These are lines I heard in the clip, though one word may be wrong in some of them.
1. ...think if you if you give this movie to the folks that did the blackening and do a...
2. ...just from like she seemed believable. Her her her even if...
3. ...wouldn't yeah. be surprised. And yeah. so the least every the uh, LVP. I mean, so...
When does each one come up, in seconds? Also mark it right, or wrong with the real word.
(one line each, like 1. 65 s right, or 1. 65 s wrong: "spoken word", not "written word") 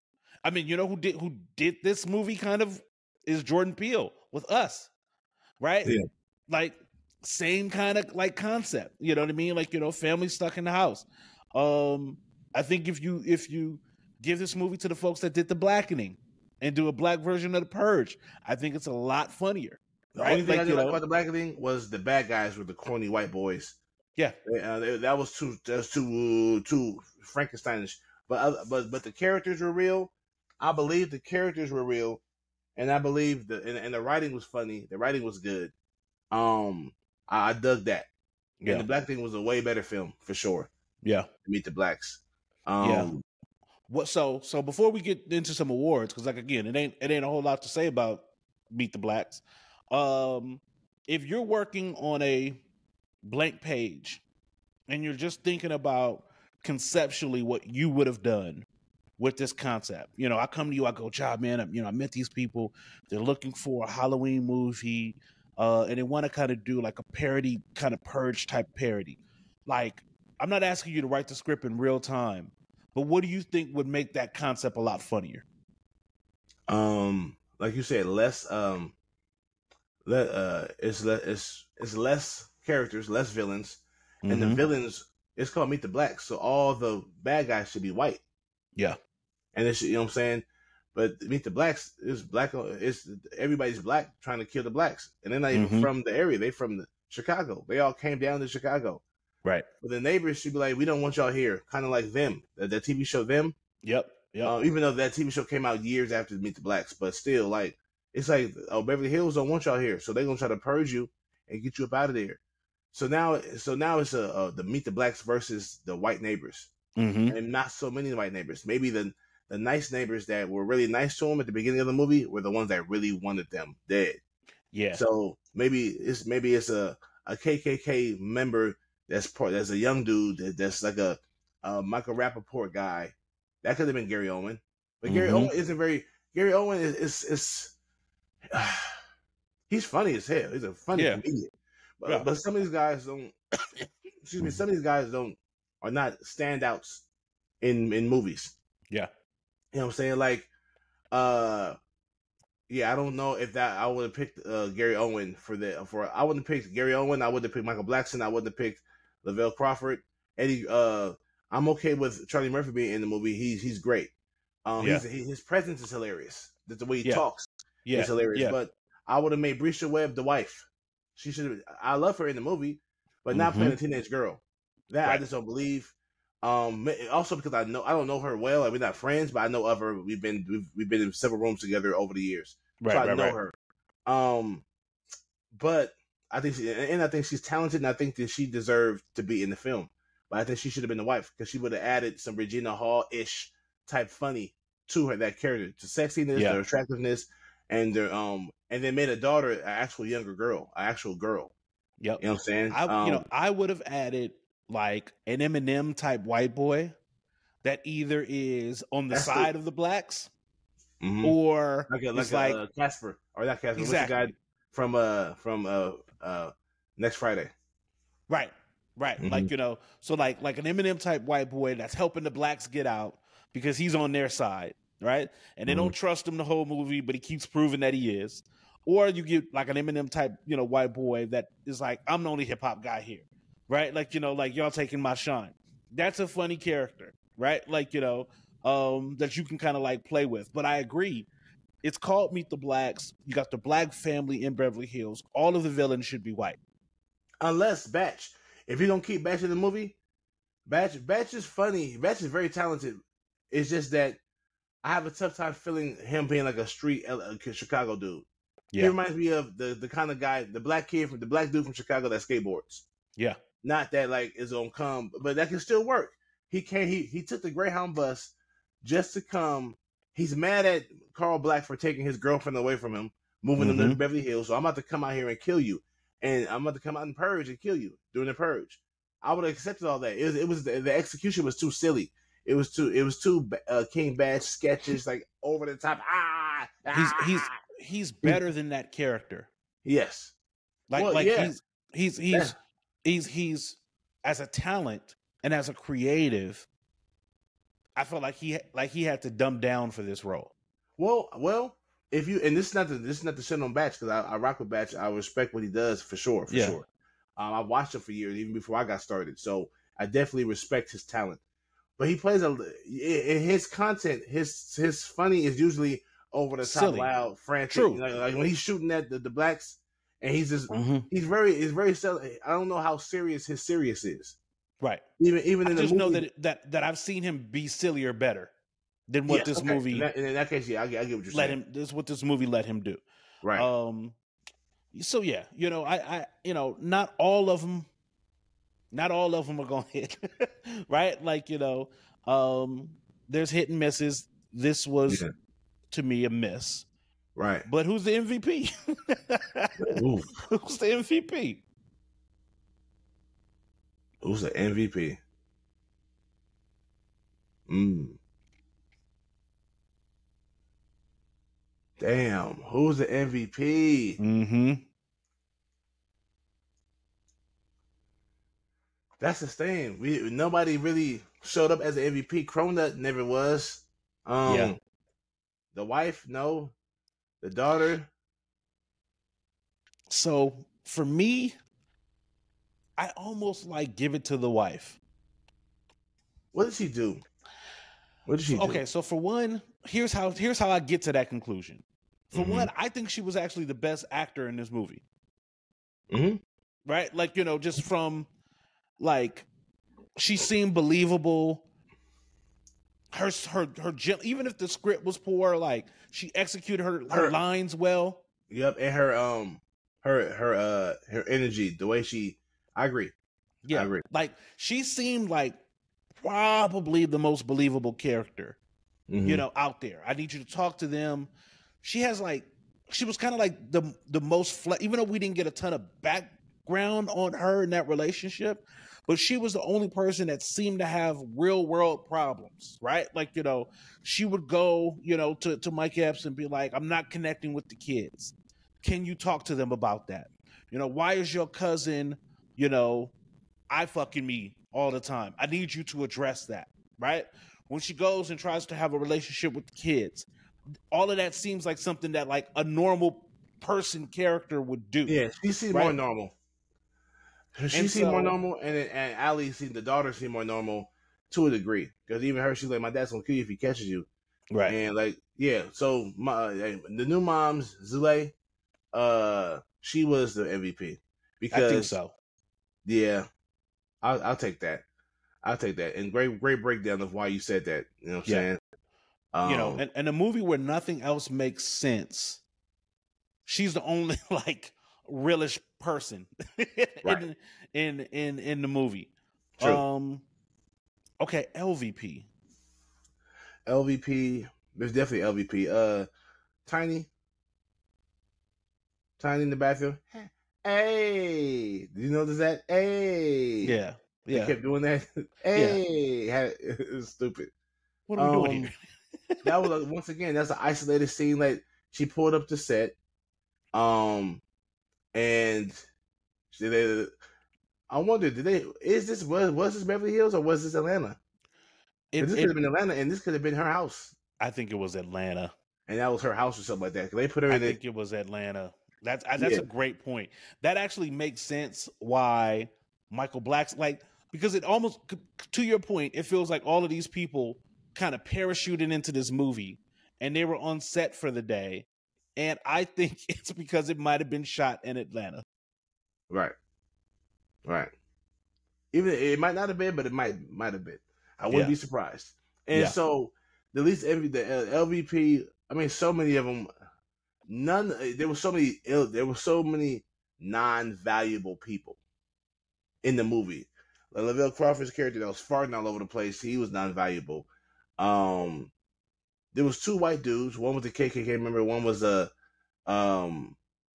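1. 12 s right
2. 397 s right
3. 551 s right.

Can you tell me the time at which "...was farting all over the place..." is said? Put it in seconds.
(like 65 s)
565 s.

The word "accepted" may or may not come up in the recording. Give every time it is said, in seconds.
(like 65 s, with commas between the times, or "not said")
279 s.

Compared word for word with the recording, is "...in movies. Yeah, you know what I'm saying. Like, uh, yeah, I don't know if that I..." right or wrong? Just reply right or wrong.
right.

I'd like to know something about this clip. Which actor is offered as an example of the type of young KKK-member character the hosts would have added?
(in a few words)
Michael Rappaport.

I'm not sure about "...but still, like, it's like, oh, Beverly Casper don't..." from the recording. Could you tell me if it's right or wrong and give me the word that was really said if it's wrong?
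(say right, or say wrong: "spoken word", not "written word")
wrong: "Hills", not "Casper".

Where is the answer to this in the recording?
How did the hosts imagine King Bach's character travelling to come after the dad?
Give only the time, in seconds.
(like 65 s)
267 s.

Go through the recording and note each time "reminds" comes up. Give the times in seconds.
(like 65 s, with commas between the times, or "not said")
258 s.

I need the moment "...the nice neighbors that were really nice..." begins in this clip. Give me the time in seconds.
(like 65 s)
119 s.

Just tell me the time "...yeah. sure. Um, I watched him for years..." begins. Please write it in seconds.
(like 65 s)
306 s.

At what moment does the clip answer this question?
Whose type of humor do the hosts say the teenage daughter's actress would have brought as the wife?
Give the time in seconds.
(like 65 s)
192 s.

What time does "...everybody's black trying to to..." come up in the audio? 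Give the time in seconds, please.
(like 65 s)
93 s.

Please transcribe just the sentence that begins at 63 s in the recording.
They're looking for a Halloween movie, uh, and they want to kind of do like a parody, kind of purge type parody.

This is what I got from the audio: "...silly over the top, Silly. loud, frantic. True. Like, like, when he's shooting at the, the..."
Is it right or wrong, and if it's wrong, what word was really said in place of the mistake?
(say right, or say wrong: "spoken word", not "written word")
wrong: "usually", not "silly".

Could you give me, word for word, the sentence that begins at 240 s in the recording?
But I agree it's called Meet the Blacks.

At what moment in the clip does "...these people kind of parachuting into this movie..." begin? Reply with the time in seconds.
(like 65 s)
536 s.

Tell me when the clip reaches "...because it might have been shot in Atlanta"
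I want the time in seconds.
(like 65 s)
543 s.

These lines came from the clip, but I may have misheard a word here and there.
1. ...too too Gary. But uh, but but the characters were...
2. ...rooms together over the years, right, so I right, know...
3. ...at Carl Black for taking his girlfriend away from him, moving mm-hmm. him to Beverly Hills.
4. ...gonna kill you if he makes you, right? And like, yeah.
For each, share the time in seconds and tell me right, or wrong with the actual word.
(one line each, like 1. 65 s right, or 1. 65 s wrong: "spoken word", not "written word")
1. 25 s wrong: "Frankensteinish", not "Gary"
2. 181 s right
3. 270 s right
4. 463 s wrong: "catches", not "makes".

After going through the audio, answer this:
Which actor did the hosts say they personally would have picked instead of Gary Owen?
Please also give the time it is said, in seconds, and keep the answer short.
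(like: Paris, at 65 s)
Michael Blackson, at 157 s.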